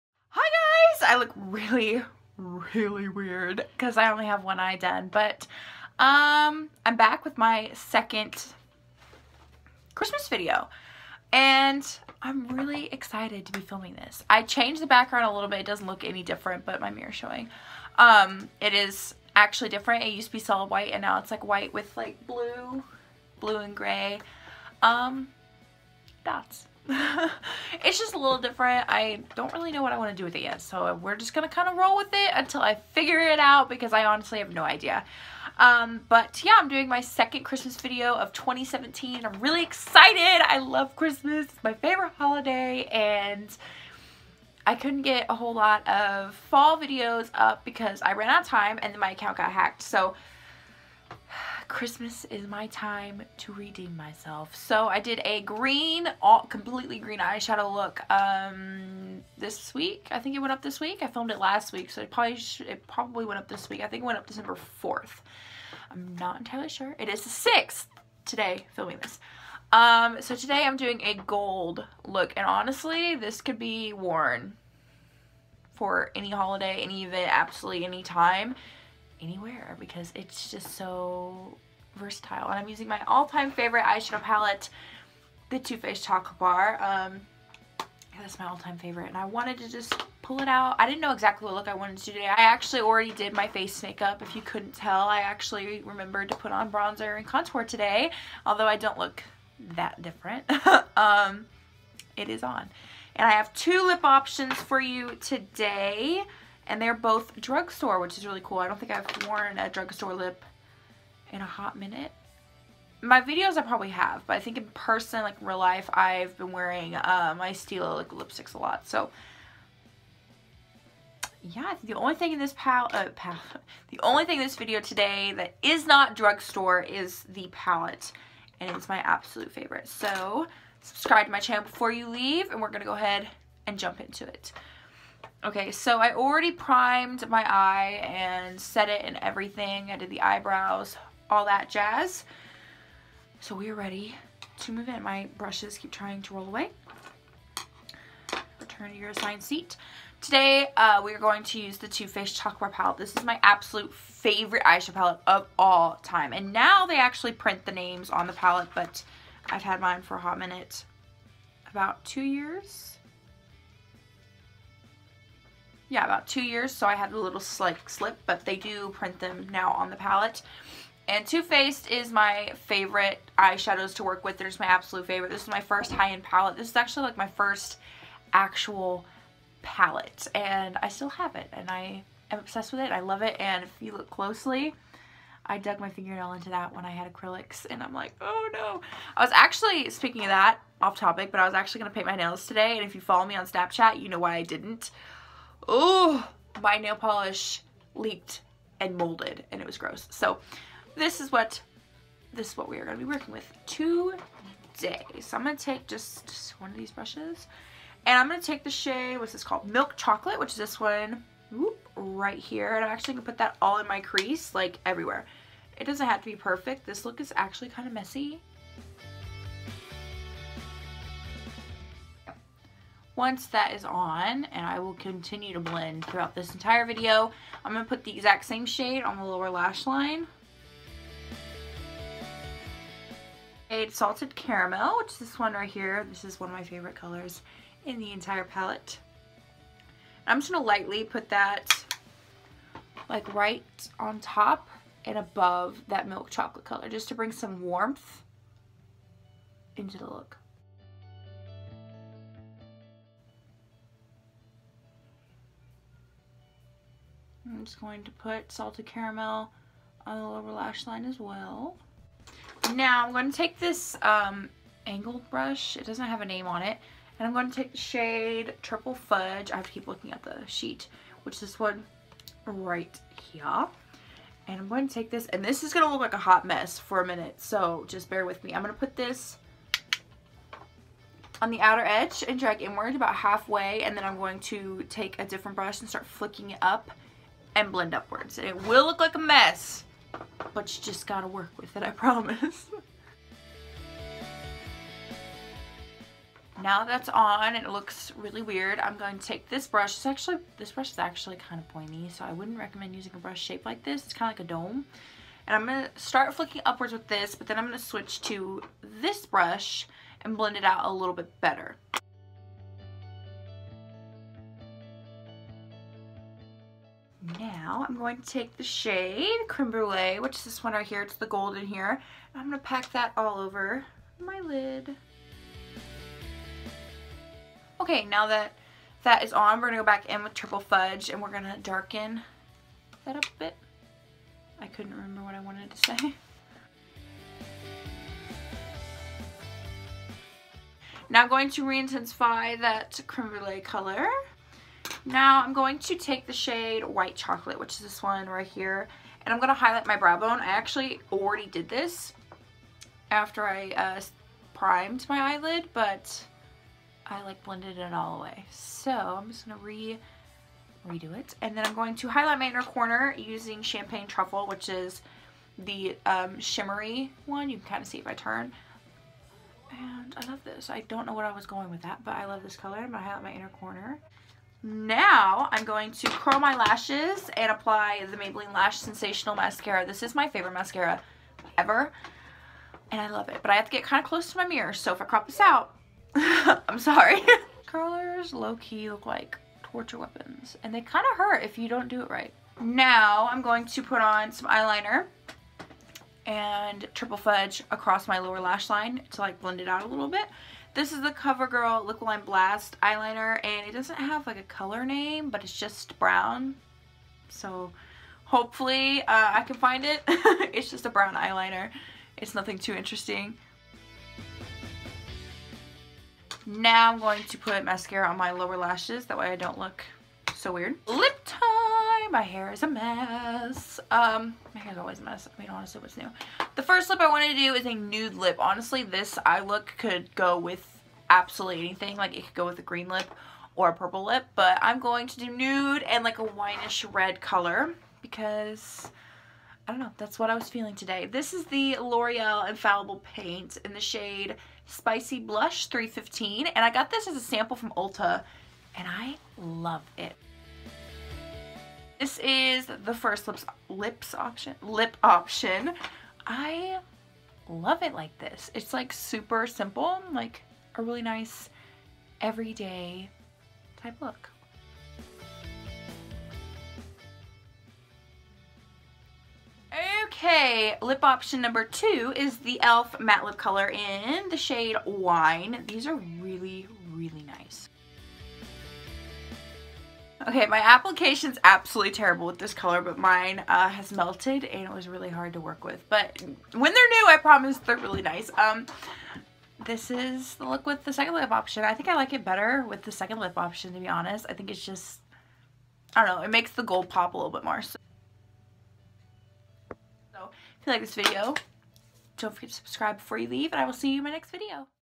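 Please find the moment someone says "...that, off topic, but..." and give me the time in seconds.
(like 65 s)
190 s.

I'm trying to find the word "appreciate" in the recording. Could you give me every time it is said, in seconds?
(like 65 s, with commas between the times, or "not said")
not said.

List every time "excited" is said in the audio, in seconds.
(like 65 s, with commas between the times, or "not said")
12 s, 39 s.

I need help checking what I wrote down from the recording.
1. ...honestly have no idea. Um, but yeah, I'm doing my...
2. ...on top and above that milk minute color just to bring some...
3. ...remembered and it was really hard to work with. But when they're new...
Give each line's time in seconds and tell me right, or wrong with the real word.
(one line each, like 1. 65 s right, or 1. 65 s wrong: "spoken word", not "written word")
1. 34 s right
2. 243 s wrong: "chocolate", not "minute"
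3. 483 s wrong: "melted", not "remembered".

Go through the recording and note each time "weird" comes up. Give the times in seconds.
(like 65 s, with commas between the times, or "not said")
3 s, 298 s, 420 s.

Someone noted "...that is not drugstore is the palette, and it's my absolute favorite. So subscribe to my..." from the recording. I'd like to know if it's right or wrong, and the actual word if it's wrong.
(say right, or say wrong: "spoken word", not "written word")
right.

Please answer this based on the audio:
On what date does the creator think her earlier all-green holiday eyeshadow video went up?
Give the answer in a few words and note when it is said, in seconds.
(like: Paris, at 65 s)
December 4th, at 64 s.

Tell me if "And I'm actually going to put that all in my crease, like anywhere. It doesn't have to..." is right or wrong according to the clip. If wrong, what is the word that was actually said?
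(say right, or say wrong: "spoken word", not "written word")
wrong: "everywhere", not "anywhere".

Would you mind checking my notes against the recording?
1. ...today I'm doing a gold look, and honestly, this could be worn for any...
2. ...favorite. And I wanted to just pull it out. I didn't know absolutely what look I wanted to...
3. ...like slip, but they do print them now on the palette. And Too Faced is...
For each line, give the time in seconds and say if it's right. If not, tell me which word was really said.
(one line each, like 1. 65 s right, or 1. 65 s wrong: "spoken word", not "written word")
1. 70 s right
2. 88 s wrong: "exactly", not "absolutely"
3. 167 s right.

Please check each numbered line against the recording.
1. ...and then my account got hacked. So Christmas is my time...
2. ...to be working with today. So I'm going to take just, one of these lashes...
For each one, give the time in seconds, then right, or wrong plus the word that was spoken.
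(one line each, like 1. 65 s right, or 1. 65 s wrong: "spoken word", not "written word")
1. 48 s right
2. 202 s wrong: "brushes", not "lashes".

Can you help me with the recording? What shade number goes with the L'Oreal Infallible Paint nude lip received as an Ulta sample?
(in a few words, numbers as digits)
315.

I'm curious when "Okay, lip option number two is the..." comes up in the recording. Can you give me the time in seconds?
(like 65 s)
470 s.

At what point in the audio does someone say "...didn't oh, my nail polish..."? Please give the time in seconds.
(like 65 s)
194 s.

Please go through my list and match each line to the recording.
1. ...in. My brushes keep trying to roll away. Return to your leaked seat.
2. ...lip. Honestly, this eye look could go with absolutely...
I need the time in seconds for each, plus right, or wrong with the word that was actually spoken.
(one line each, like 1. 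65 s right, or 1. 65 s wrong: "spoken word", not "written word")
1. 144 s wrong: "assigned", not "leaked"
2. 428 s right.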